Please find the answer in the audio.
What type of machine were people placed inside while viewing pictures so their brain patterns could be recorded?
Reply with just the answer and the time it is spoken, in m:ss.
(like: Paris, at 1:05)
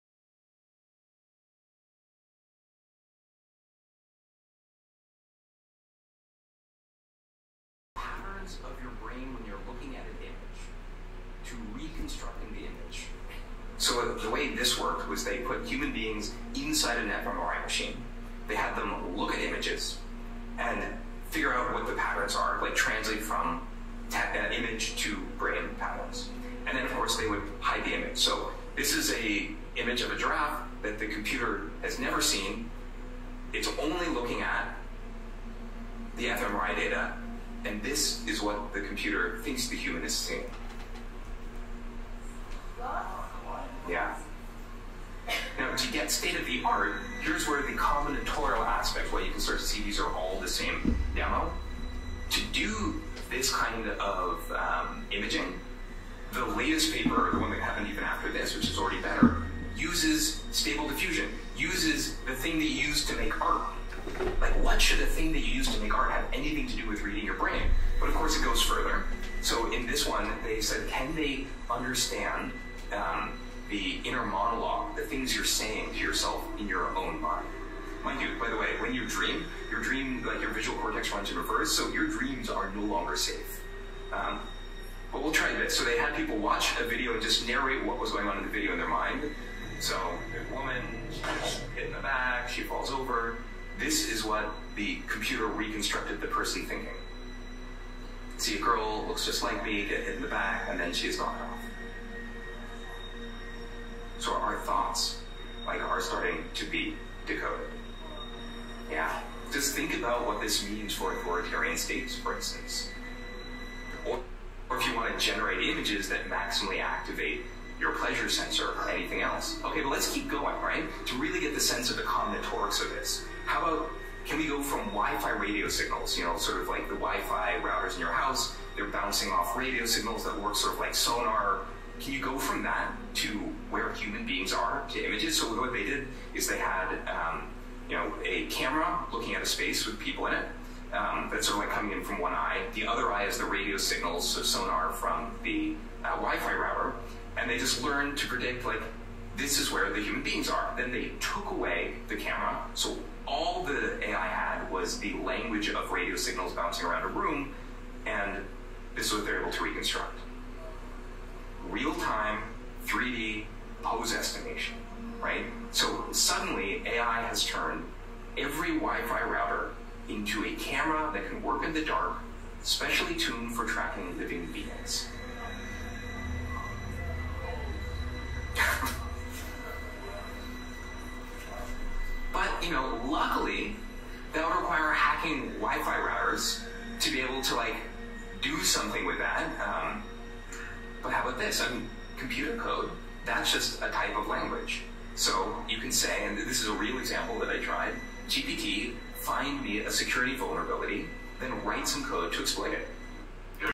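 fMRI machine, at 0:17.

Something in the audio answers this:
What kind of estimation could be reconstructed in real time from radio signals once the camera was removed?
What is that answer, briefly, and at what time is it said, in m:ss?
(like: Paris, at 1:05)
3D pose estimation, at 2:42.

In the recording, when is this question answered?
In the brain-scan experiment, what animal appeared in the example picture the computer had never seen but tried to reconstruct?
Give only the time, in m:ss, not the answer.
0:30.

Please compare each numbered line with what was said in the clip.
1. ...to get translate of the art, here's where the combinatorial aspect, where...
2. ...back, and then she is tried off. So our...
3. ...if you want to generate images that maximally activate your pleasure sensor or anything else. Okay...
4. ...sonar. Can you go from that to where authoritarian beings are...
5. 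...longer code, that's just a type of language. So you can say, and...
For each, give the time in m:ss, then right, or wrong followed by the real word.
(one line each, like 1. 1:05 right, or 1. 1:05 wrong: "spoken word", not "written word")
1. 0:45 wrong: "state", not "translate"
2. 1:40 wrong: "knocked", not "tried"
3. 1:54 right
4. 2:10 wrong: "human", not "authoritarian"
5. 3:12 wrong: "computer", not "longer".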